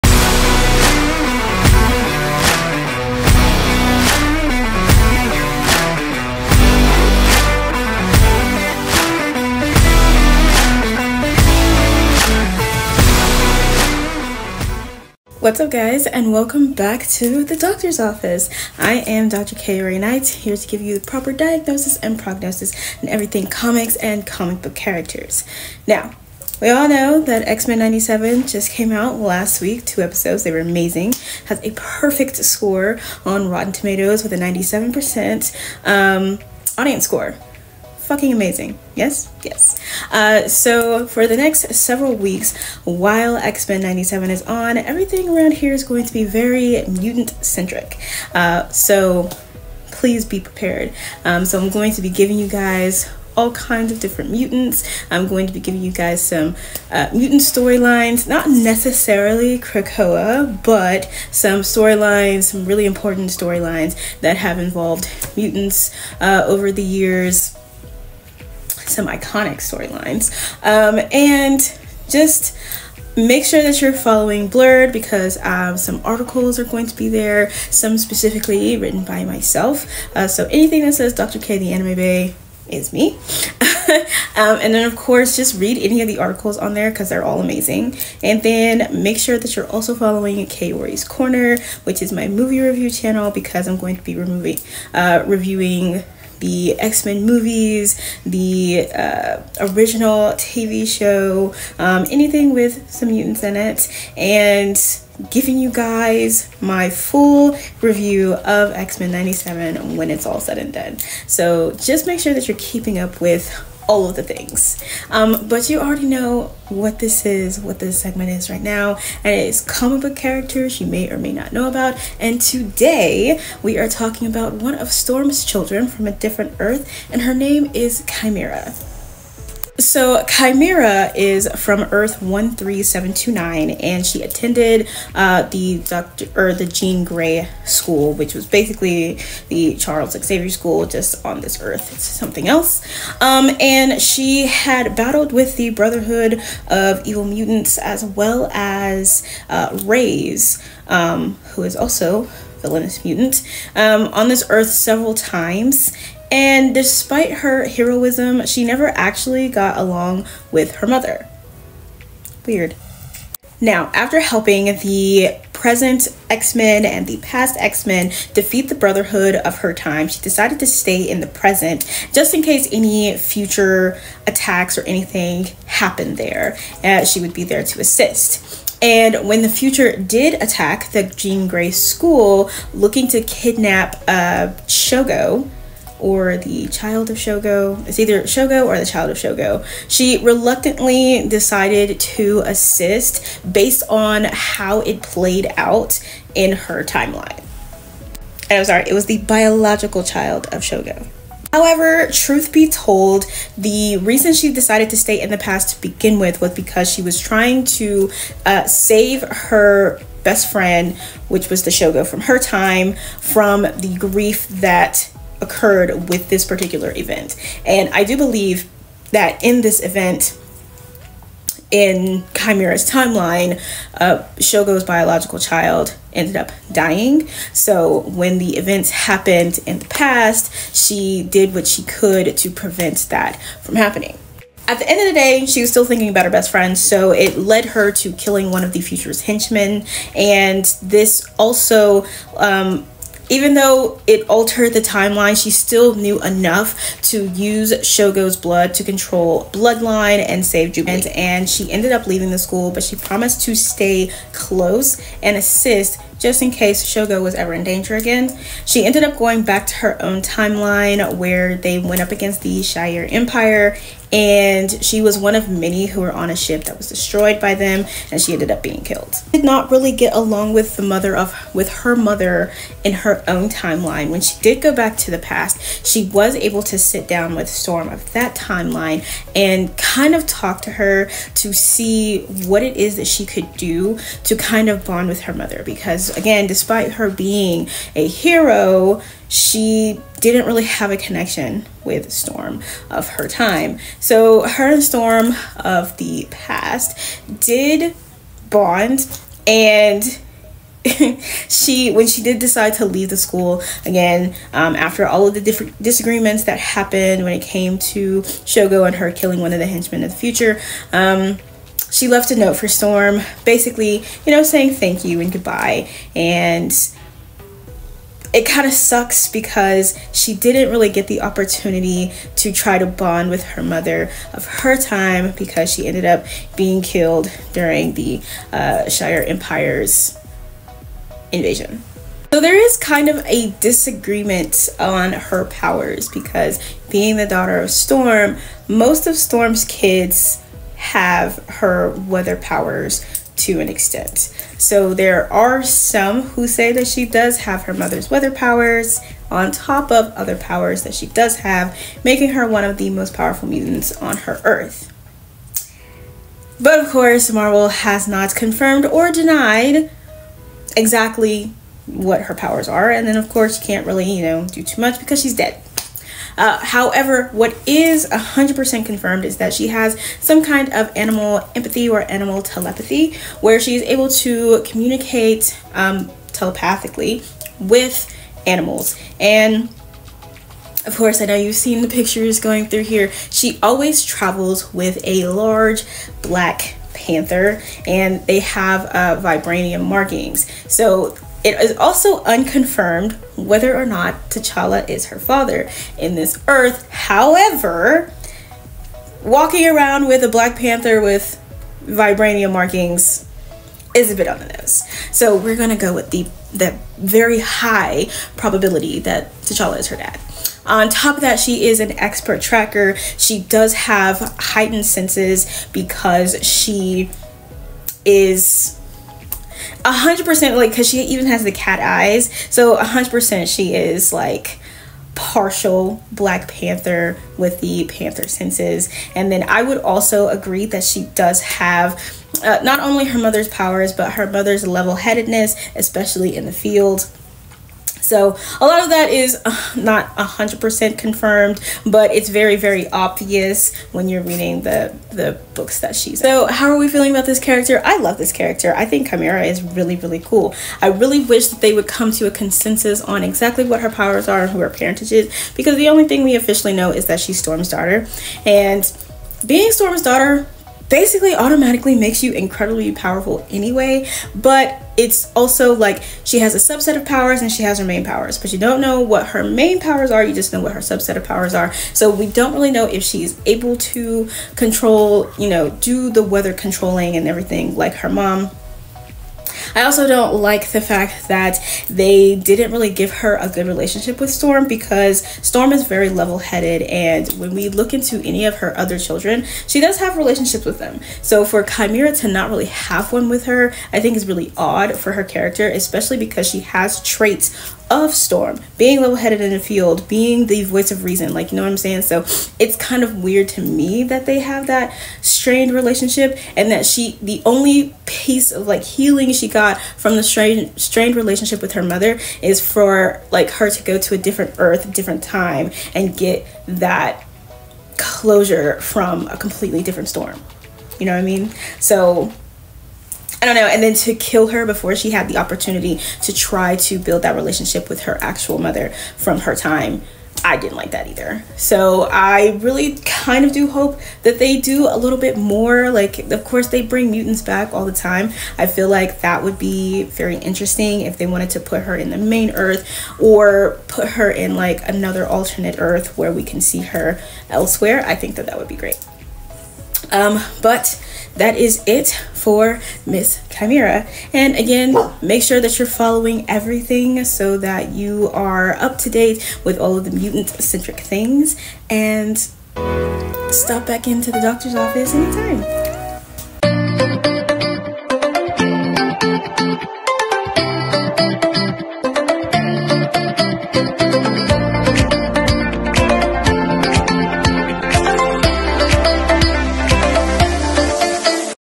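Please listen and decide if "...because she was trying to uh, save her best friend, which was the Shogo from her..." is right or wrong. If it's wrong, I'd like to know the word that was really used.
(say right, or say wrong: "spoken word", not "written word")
right.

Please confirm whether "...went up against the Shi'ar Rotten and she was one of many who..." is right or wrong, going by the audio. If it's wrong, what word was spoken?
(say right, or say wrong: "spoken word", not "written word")
wrong: "Empire", not "Rotten".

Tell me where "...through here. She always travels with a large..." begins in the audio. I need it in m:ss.
6:22.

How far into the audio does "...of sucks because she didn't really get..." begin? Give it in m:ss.
5:18.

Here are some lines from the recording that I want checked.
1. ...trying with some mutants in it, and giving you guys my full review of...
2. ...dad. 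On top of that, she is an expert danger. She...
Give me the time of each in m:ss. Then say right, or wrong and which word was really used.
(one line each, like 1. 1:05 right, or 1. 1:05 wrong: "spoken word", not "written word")
1. 1:42 wrong: "anything", not "trying"
2. 6:49 wrong: "tracker", not "danger".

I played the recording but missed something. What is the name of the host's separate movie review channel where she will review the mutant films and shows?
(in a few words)
Kaori's corner.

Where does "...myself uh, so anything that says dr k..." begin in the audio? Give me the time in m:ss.
1:19.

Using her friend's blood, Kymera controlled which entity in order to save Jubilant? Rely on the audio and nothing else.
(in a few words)
Bloodline.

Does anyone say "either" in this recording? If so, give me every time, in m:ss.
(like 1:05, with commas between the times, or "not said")
3:07, 8:51.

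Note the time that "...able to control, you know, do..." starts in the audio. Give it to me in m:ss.
7:53.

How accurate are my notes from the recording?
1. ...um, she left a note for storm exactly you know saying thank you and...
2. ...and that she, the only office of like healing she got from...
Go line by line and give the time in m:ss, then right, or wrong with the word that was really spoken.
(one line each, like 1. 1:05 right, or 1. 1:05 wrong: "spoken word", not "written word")
1. 5:10 wrong: "basically", not "exactly"
2. 8:26 wrong: "piece", not "office".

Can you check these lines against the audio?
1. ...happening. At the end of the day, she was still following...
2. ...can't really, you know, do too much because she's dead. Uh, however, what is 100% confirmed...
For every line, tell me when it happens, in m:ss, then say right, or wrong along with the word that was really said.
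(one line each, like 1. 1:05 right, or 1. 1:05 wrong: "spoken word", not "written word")
1. 3:53 wrong: "thinking", not "following"
2. 6:03 right.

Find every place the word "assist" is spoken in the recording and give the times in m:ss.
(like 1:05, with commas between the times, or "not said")
2:57, 3:12, 4:15.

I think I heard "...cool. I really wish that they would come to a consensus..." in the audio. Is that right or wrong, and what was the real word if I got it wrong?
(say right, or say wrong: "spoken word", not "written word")
right.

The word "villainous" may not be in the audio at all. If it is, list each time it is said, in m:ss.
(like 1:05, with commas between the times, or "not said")
2:32.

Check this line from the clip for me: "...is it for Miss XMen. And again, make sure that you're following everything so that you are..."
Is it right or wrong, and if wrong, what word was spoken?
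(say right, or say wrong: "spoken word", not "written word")
wrong: "Kymera", not "XMen".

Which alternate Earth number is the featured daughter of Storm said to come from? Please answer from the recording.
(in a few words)
Earth 13729.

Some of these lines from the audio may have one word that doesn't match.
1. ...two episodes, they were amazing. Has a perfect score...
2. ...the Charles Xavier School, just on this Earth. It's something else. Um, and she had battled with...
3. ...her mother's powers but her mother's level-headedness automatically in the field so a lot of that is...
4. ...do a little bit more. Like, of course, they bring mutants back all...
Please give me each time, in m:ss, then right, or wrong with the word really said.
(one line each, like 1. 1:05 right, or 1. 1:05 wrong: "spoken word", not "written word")
1. 0:29 right
2. 2:19 right
3. 7:13 wrong: "especially", not "automatically"
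4. 8:54 right.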